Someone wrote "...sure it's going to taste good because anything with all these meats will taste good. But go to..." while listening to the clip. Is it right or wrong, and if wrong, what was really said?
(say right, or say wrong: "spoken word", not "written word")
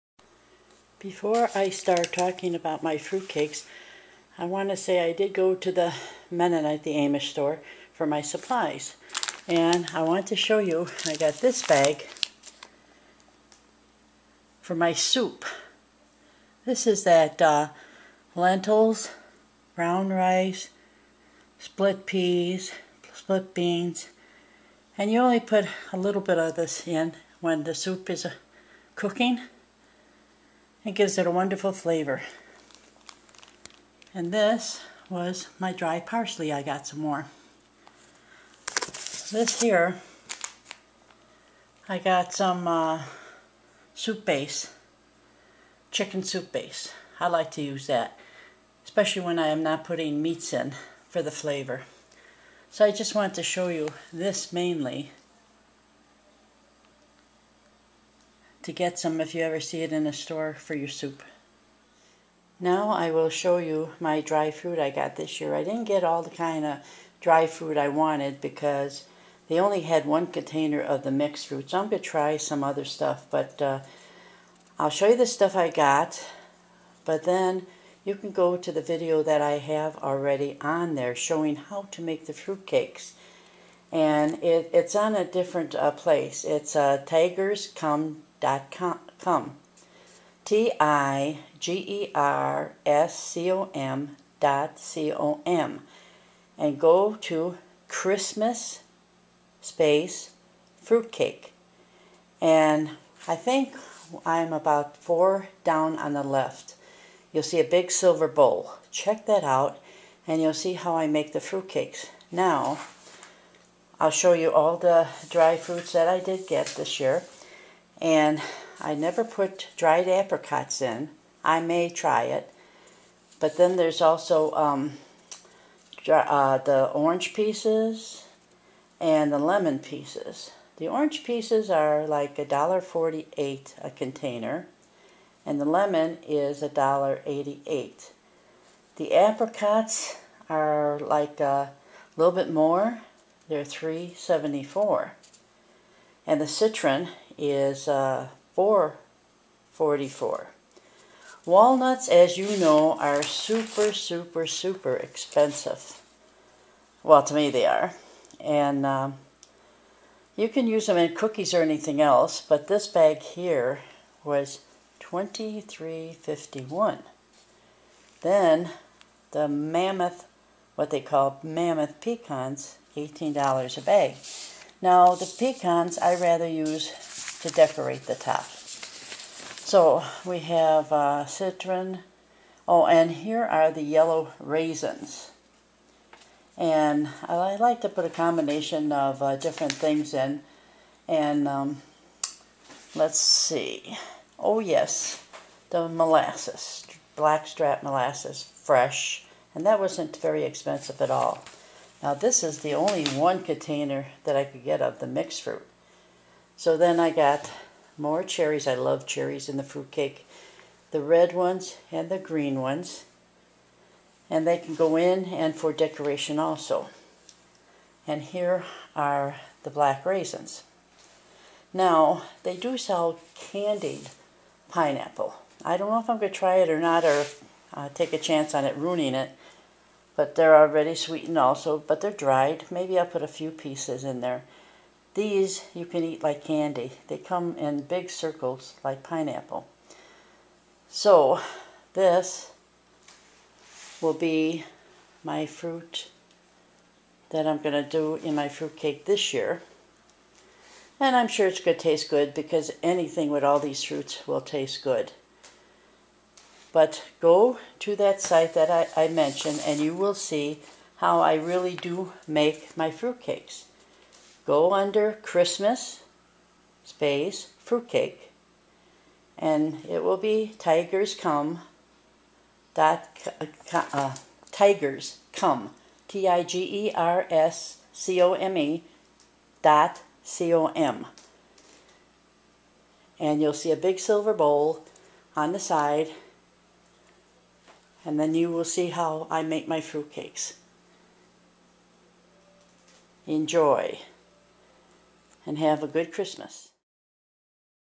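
wrong: "fruits", not "meats".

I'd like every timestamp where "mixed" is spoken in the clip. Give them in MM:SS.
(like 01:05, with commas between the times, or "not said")
01:11, 03:25.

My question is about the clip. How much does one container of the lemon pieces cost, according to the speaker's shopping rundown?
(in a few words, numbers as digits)
$1.88.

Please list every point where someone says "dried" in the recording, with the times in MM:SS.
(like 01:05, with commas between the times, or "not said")
01:59, 03:52.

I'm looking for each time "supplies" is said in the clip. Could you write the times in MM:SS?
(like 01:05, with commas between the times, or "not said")
00:08.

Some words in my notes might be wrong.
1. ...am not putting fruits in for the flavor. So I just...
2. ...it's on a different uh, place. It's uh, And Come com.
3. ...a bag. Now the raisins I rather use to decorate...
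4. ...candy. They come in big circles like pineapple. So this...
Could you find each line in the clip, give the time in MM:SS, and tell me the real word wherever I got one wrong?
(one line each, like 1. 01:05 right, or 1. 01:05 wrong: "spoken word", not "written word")
1. 00:49 wrong: "meats", not "fruits"
2. 01:24 wrong: "Tigers", not "And"
3. 02:53 wrong: "pecans", not "raisins"
4. 03:56 right.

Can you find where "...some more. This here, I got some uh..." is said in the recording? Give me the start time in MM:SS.
00:36.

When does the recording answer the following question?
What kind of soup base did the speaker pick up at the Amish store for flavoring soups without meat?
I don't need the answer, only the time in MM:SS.
00:45.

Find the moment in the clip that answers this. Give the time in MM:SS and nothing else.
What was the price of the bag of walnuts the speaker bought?
02:44.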